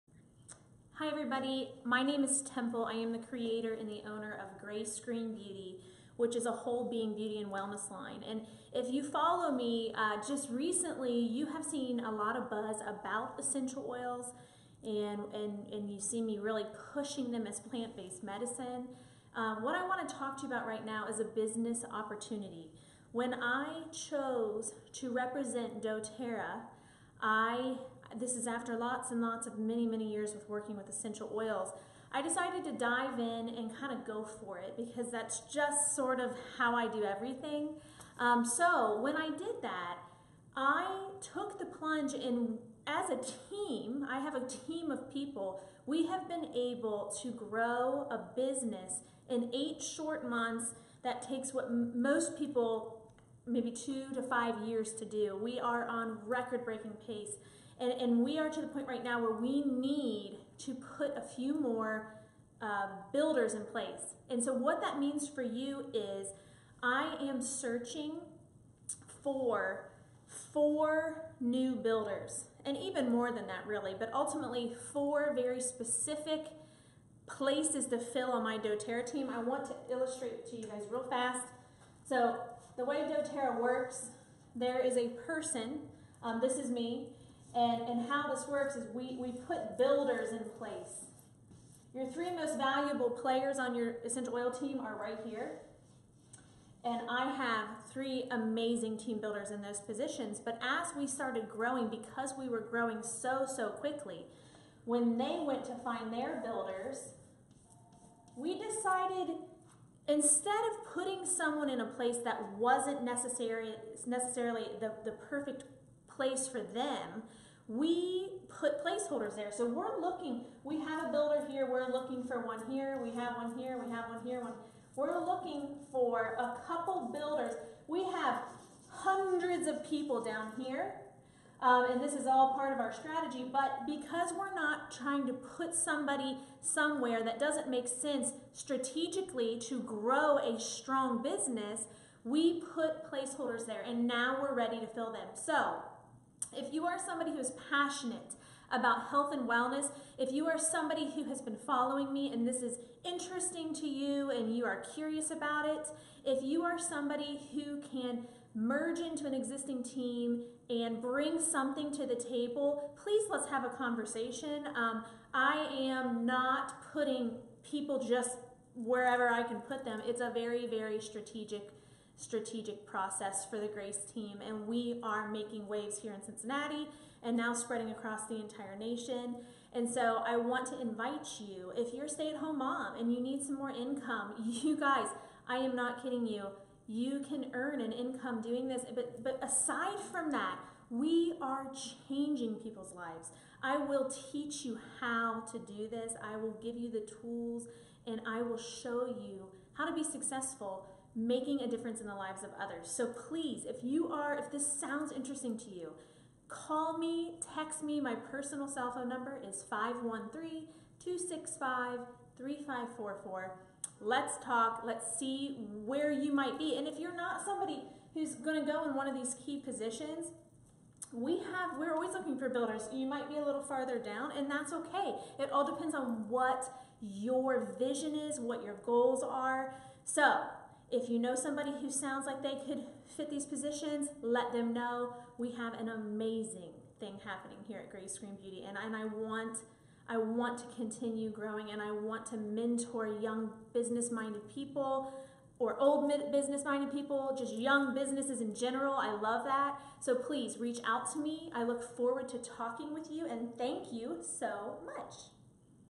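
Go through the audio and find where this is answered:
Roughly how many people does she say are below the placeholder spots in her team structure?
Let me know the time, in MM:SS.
02:08.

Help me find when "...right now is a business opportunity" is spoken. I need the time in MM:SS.
00:20.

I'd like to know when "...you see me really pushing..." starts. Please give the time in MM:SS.
00:15.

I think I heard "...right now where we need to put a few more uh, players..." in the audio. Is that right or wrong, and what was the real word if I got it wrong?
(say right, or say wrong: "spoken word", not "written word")
wrong: "builders", not "players".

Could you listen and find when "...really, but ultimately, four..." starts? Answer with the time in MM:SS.
01:13.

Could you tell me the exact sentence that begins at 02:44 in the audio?
Um, I am not putting people just wherever I can put them.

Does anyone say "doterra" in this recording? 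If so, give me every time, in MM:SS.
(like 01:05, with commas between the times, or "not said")
00:25, 01:18, 01:23.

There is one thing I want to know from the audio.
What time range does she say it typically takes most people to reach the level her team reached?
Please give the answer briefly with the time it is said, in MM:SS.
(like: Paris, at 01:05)
2 to 5 years, at 00:53.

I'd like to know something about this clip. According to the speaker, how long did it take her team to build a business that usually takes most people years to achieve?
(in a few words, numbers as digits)
8 months.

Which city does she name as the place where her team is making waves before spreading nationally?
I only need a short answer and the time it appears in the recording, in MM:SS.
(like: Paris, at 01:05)
Cincinnati, at 02:56.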